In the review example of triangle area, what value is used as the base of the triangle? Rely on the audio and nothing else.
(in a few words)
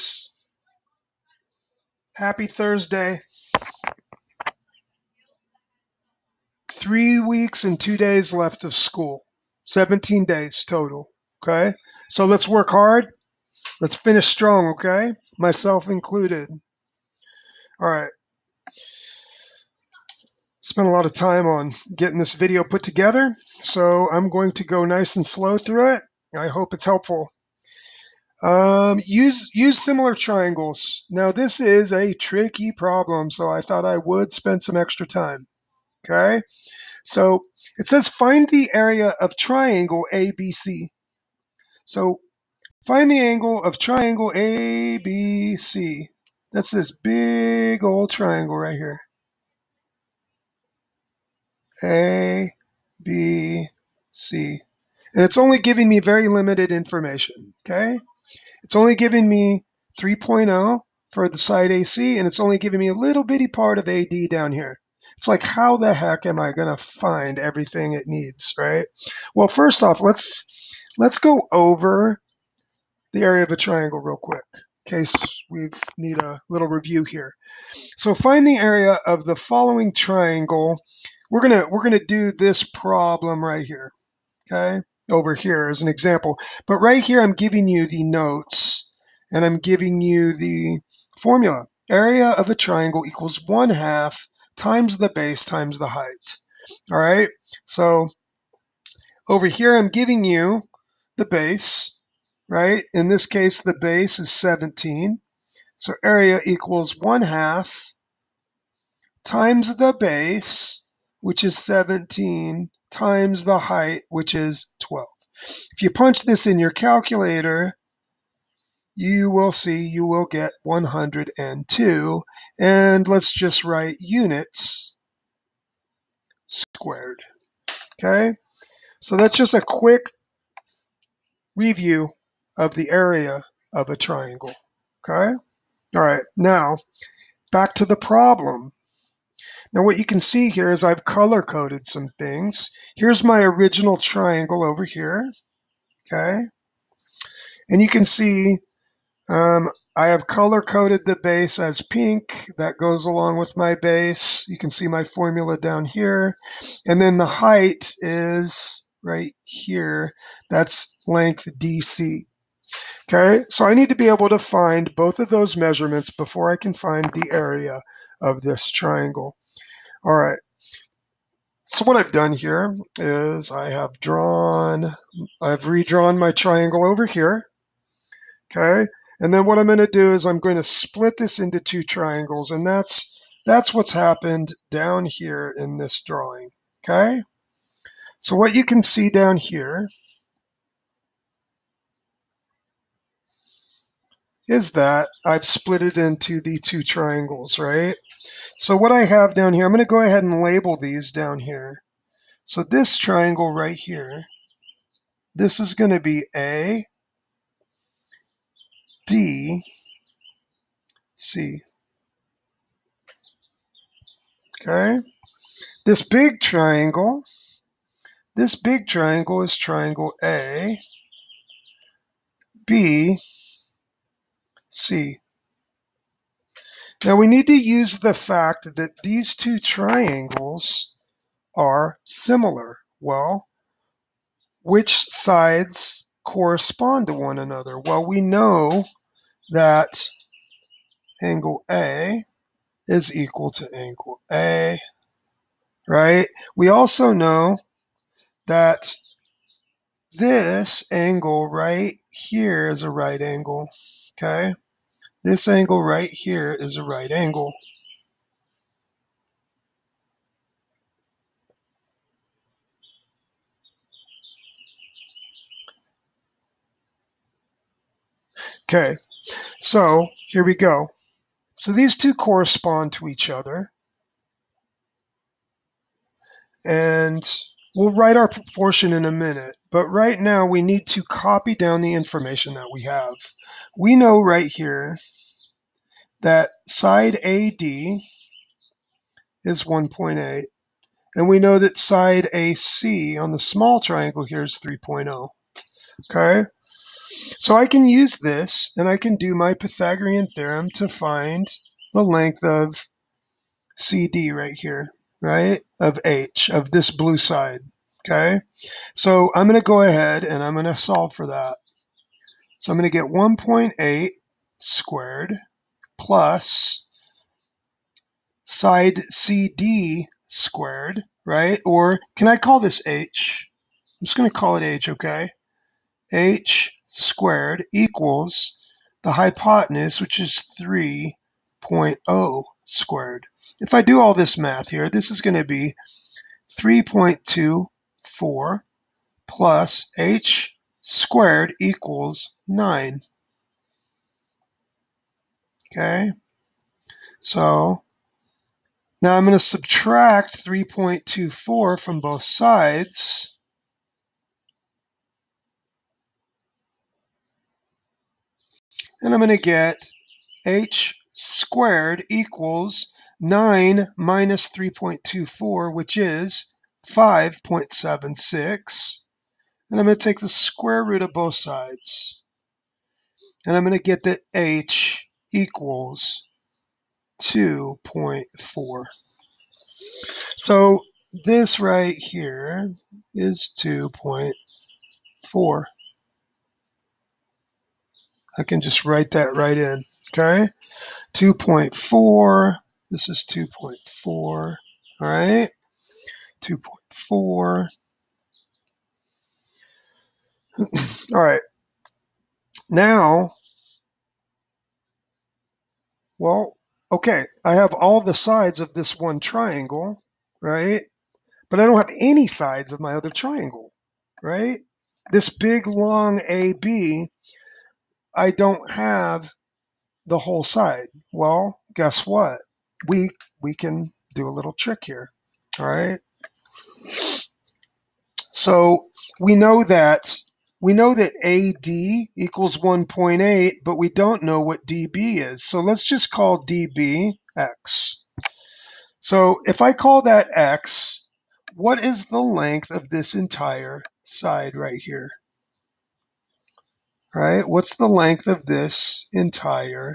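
17.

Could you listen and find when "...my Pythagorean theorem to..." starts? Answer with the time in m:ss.
4:59.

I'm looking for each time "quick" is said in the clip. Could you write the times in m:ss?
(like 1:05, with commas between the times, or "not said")
1:14, 2:09.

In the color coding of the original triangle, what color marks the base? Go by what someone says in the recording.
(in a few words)
pink.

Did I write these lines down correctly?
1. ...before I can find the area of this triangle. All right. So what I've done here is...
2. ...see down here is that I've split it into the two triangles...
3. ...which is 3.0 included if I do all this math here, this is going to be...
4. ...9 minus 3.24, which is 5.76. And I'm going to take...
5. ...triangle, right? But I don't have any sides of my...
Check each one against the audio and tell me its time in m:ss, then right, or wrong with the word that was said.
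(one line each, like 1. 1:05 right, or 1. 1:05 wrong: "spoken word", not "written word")
1. 2:46 right
2. 3:08 right
3. 5:30 wrong: "squared", not "included"
4. 6:03 right
5. 6:49 right.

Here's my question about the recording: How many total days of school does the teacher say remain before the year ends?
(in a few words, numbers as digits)
17.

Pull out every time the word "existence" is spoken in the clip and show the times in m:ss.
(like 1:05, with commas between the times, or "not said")
not said.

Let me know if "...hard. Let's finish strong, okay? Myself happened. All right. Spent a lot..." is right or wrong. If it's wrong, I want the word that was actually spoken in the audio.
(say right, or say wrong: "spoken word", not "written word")
wrong: "included", not "happened".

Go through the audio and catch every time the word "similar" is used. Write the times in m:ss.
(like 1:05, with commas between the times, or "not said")
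0:29, 3:52.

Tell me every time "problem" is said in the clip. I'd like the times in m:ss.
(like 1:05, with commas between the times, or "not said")
0:32, 1:22, 2:17.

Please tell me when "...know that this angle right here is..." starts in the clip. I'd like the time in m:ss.
4:07.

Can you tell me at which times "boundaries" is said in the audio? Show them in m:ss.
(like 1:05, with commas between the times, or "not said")
not said.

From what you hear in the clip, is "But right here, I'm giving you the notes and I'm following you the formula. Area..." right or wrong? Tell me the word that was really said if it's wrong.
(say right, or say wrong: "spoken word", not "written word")
wrong: "giving", not "following".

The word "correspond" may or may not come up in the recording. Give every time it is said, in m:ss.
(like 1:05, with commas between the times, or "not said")
3:56, 4:32.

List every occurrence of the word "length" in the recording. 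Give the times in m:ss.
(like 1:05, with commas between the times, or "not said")
2:41, 5:02, 7:22, 7:27.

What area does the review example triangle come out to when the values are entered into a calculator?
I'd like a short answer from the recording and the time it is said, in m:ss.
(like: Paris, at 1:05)
102, at 2:00.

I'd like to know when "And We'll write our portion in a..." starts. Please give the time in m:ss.
4:36.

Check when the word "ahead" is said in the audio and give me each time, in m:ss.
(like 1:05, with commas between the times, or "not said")
3:20, 5:09.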